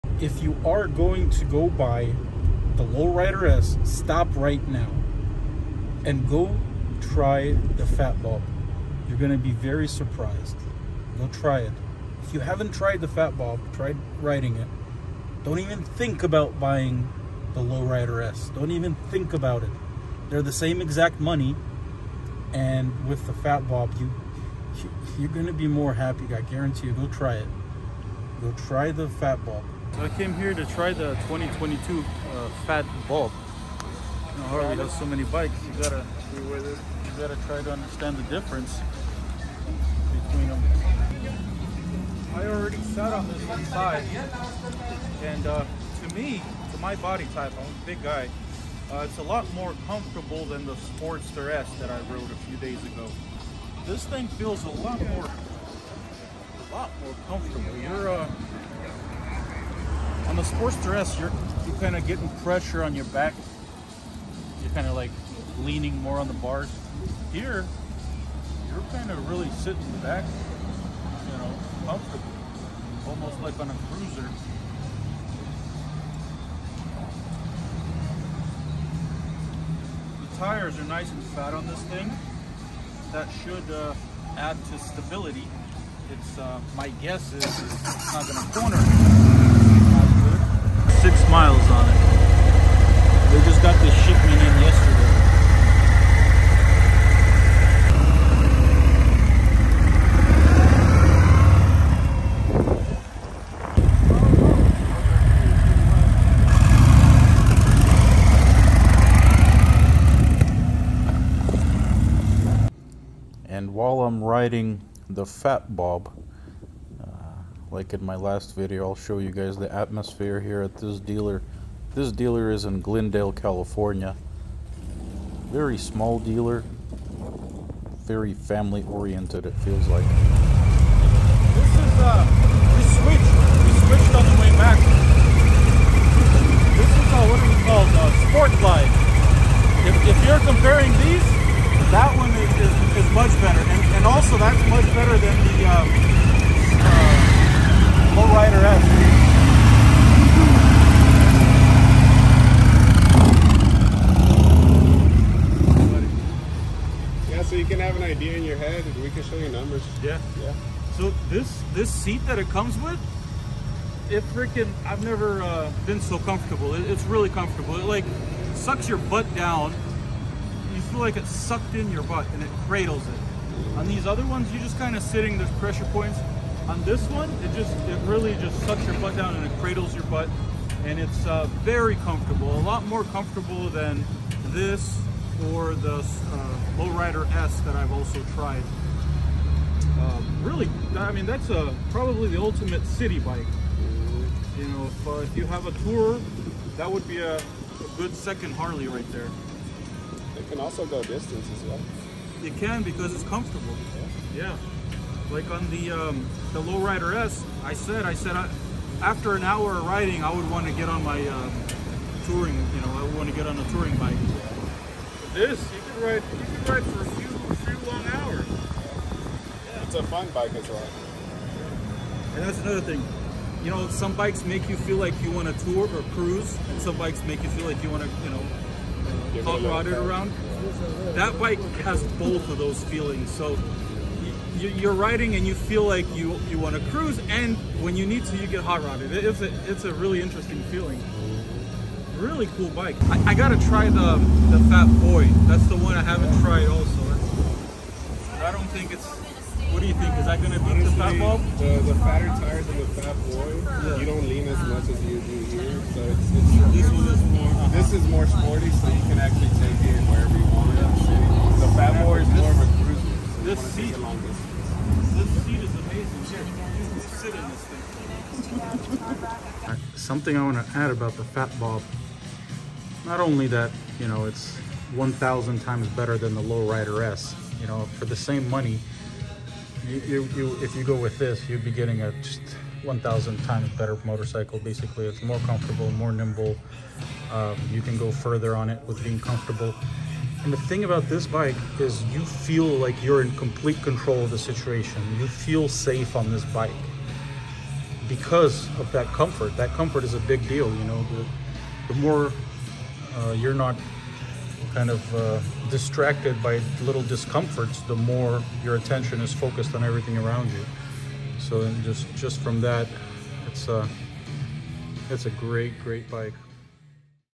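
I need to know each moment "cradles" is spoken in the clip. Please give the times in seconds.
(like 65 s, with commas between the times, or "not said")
172 s, 179 s.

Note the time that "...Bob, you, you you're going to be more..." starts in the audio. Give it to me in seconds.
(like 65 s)
23 s.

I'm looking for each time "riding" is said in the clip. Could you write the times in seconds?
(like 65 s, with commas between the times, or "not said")
14 s, 114 s, 209 s, 234 s.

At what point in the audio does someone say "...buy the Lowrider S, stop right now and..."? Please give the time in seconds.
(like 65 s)
1 s.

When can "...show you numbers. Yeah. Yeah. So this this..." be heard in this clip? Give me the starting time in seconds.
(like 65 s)
159 s.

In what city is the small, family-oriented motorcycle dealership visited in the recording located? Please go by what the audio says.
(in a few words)
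Glendale, California.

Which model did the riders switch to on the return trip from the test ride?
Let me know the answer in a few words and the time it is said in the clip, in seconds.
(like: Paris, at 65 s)
Sport Glide, at 138 s.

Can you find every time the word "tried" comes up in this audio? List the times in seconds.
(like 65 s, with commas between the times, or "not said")
12 s, 188 s, 246 s.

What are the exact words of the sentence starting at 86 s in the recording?
It's uh, my guess is it's not going to corner miles on it.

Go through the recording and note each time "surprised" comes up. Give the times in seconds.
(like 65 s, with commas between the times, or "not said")
9 s.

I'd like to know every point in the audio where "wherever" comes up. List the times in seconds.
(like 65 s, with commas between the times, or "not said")
260 s.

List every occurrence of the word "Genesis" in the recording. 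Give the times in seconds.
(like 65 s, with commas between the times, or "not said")
not said.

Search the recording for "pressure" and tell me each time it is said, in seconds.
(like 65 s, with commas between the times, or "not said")
62 s, 175 s.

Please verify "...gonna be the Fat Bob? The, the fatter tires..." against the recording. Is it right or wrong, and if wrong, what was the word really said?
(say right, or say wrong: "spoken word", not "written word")
right.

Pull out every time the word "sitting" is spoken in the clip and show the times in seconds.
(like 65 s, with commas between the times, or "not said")
69 s, 175 s.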